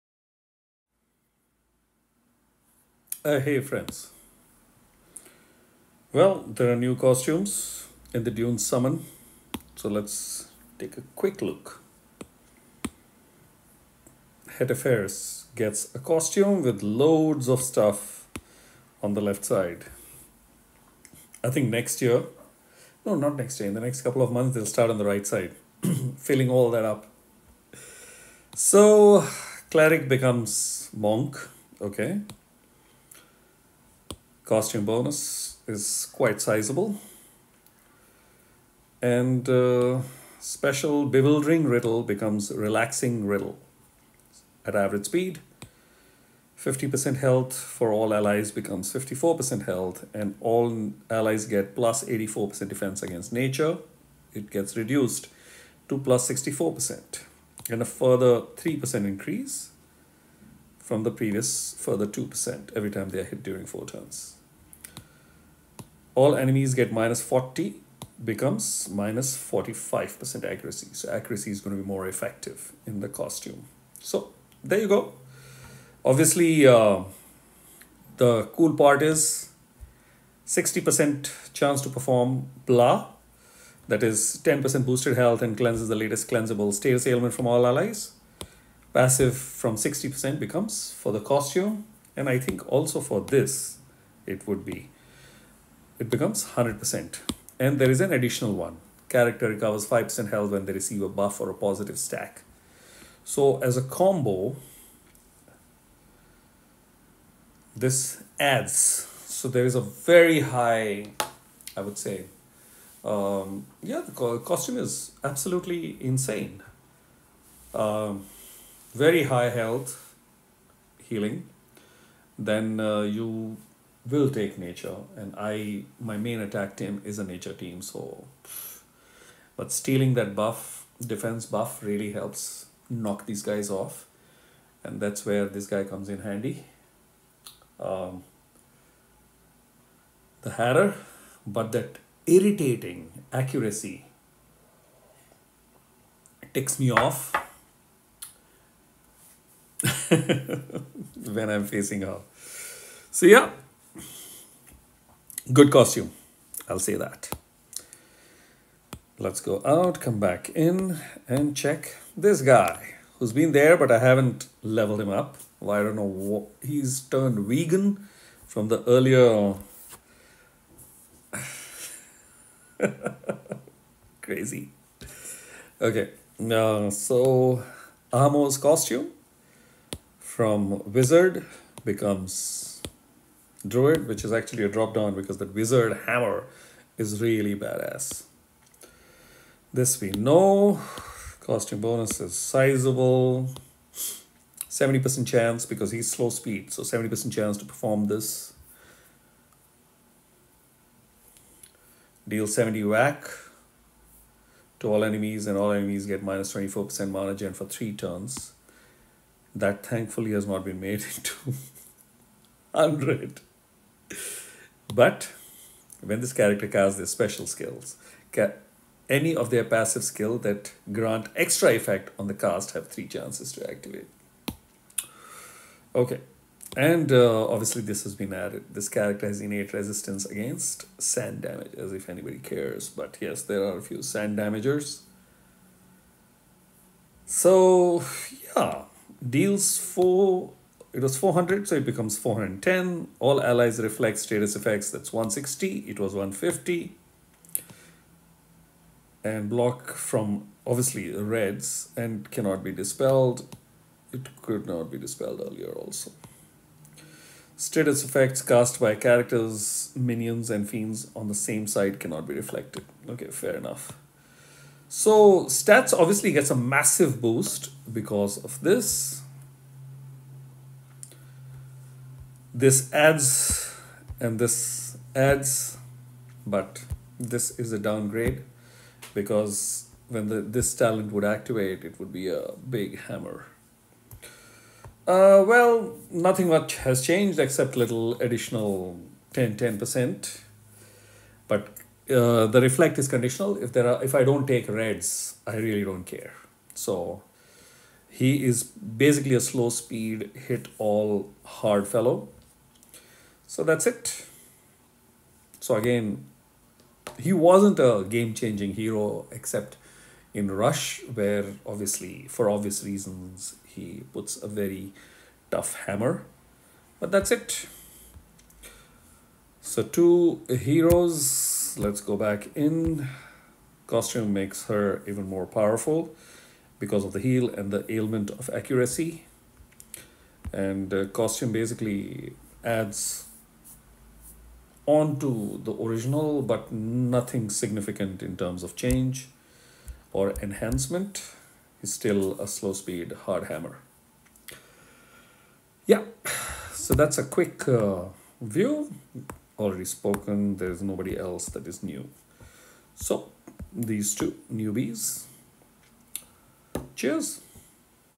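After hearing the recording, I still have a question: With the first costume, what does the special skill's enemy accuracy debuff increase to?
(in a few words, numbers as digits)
-45%.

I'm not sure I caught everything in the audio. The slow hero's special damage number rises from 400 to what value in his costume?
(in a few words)
410.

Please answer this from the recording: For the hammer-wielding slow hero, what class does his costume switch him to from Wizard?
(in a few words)
Druid.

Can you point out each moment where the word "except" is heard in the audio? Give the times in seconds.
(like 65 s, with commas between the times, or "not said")
287 s, 309 s.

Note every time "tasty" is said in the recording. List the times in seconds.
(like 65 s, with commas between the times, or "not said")
not said.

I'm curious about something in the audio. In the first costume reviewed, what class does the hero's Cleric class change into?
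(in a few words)
Monk.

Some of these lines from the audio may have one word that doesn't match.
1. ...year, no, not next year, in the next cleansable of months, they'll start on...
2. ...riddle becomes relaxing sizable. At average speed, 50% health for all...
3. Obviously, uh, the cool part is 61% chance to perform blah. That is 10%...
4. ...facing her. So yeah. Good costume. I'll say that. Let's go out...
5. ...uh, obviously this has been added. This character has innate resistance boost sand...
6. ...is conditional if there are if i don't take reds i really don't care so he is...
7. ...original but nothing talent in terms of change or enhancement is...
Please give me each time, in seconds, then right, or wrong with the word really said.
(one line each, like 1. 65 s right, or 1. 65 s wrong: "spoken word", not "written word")
1. 22 s wrong: "couple", not "cleansable"
2. 41 s wrong: "riddle", not "sizable"
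3. 76 s wrong: "60", not "61"
4. 151 s right
5. 227 s wrong: "against", not "boost"
6. 292 s right
7. 335 s wrong: "significant", not "talent".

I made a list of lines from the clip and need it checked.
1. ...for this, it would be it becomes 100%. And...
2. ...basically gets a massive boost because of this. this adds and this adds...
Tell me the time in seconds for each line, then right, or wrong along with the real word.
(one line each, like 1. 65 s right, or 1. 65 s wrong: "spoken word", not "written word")
1. 93 s right
2. 265 s wrong: "obviously", not "basically".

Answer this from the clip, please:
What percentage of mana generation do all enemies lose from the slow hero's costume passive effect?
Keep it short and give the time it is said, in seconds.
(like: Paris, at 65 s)
24%, at 206 s.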